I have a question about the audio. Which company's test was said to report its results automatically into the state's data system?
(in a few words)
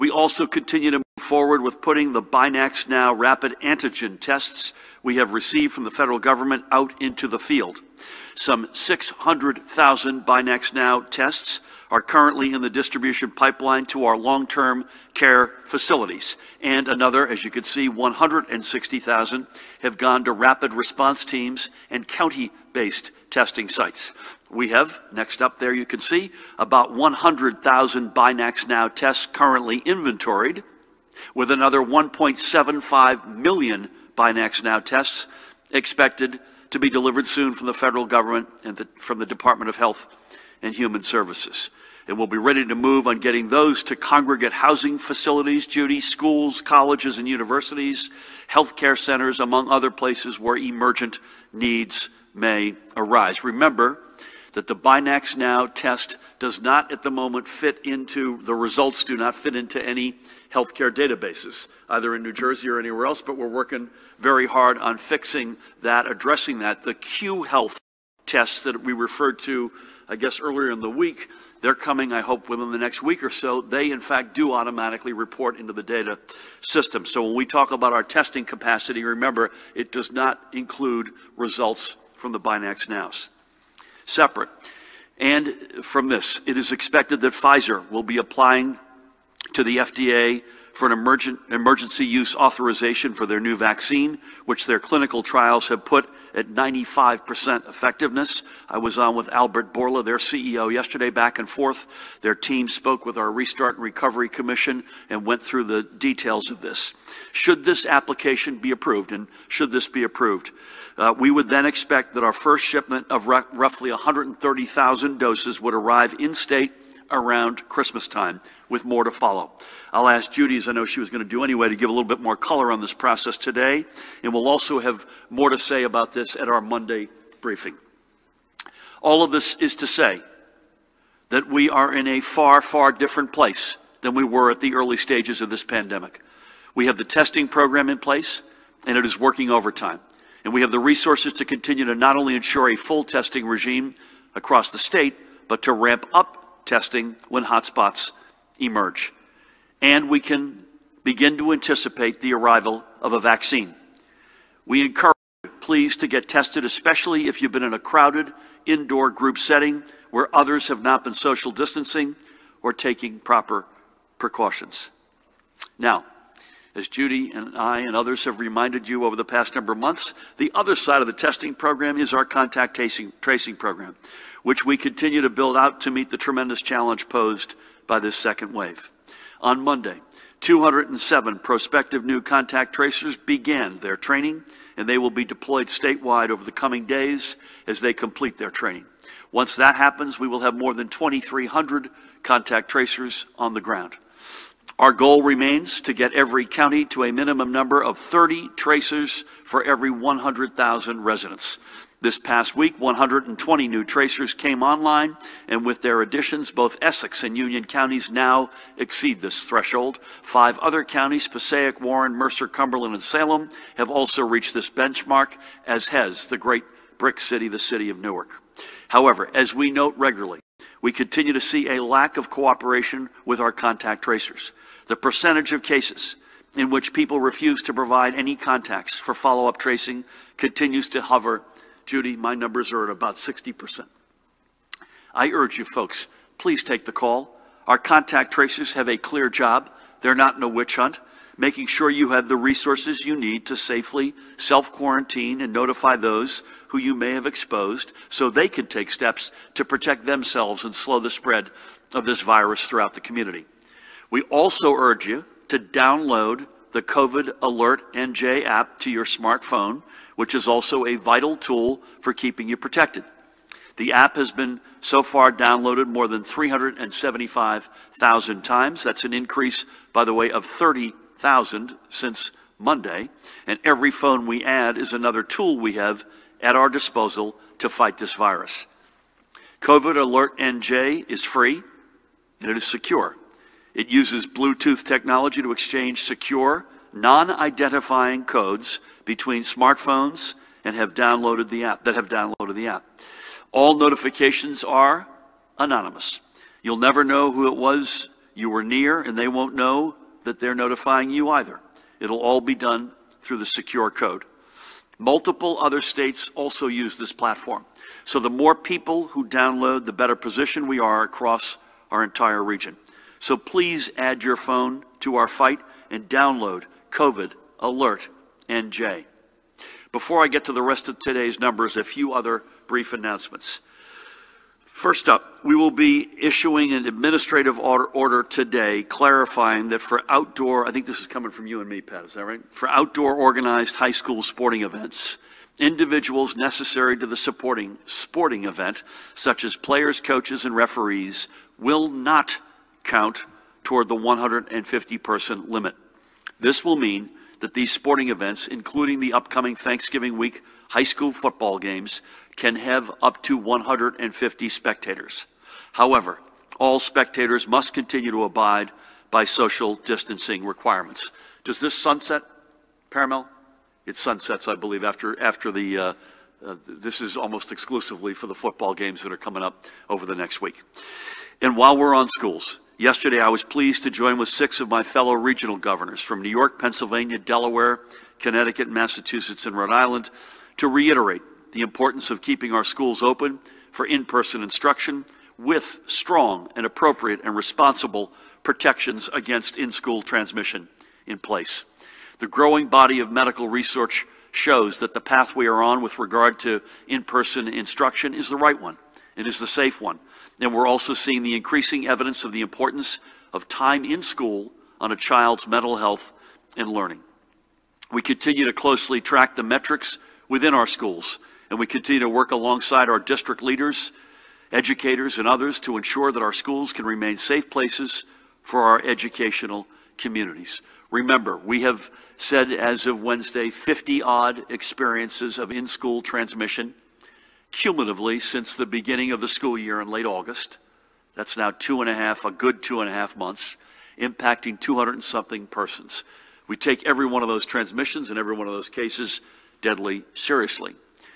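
Cue Health.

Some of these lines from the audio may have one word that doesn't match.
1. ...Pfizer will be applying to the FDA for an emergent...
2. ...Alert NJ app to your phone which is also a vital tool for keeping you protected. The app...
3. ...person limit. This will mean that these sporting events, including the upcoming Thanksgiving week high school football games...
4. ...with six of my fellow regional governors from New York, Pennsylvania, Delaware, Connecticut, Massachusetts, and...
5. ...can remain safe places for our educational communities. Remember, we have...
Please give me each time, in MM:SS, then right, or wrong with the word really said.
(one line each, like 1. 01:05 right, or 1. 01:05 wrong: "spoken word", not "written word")
1. 01:27 right
2. 04:17 wrong: "smartphone", not "phone"
3. 05:44 right
4. 06:14 right
5. 06:56 right.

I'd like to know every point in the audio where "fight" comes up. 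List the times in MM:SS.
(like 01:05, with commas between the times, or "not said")
04:37, 05:15.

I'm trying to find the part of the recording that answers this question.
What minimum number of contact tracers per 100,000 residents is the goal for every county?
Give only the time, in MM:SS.
03:17.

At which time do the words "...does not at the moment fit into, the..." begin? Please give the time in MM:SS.
00:56.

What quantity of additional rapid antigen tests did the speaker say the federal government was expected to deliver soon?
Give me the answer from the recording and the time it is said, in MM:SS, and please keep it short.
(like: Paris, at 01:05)
1.75 million, at 00:31.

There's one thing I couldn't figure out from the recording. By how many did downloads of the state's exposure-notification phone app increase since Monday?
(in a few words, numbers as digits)
30,000.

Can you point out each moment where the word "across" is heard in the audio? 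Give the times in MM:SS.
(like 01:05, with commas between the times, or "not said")
02:24, 05:11.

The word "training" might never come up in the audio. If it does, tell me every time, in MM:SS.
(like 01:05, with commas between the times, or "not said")
03:03, 03:08.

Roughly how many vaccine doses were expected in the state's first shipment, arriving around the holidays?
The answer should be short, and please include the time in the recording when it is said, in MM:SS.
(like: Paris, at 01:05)
130,000, at 01:53.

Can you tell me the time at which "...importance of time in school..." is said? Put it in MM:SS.
06:42.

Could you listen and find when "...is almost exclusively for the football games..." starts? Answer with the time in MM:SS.
06:07.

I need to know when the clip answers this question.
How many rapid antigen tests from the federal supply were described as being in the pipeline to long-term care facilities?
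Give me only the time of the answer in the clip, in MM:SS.
00:08.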